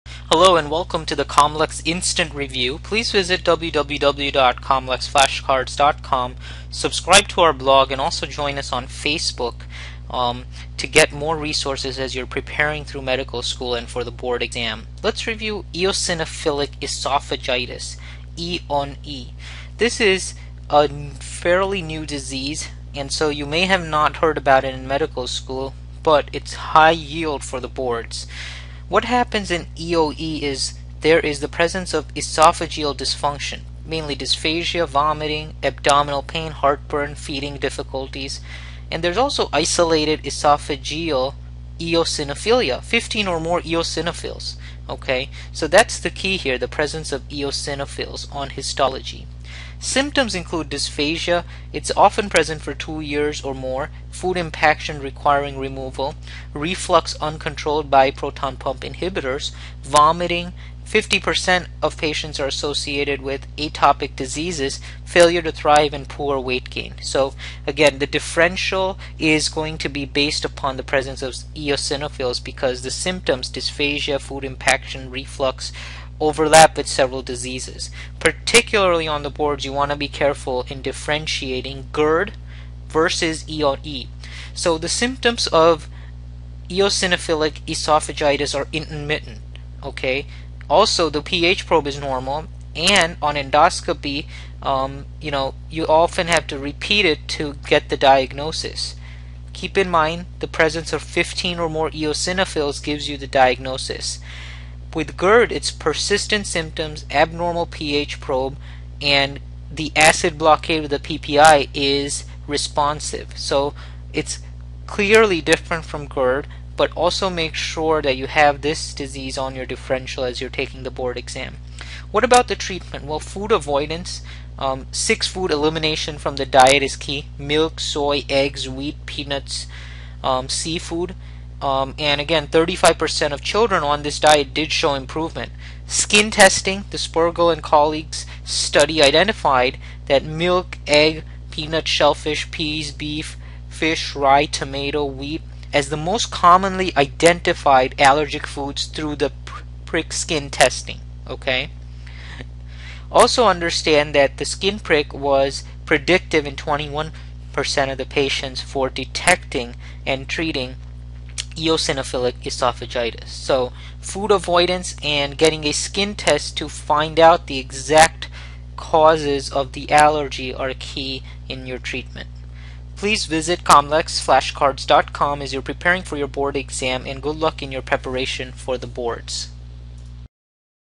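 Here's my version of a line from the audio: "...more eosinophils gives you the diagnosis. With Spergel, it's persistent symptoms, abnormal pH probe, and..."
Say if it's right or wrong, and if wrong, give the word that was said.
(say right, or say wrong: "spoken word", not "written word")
wrong: "GERD", not "Spergel".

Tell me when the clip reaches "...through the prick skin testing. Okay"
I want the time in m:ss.
2:28.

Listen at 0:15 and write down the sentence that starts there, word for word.
Let's review eosinophilic esophagitis, E on E.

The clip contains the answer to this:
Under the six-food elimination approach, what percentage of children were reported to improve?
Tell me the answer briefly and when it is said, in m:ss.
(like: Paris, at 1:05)
35%, at 2:12.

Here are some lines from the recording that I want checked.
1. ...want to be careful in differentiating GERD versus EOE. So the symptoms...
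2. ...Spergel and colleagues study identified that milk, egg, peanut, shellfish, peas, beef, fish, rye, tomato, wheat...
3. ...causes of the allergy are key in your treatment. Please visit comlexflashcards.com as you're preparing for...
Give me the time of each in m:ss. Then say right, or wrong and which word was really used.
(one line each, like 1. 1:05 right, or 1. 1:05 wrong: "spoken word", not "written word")
1. 1:19 right
2. 2:16 right
3. 2:48 right.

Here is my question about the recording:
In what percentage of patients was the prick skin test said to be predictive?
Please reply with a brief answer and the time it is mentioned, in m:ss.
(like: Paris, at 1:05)
21%, at 2:36.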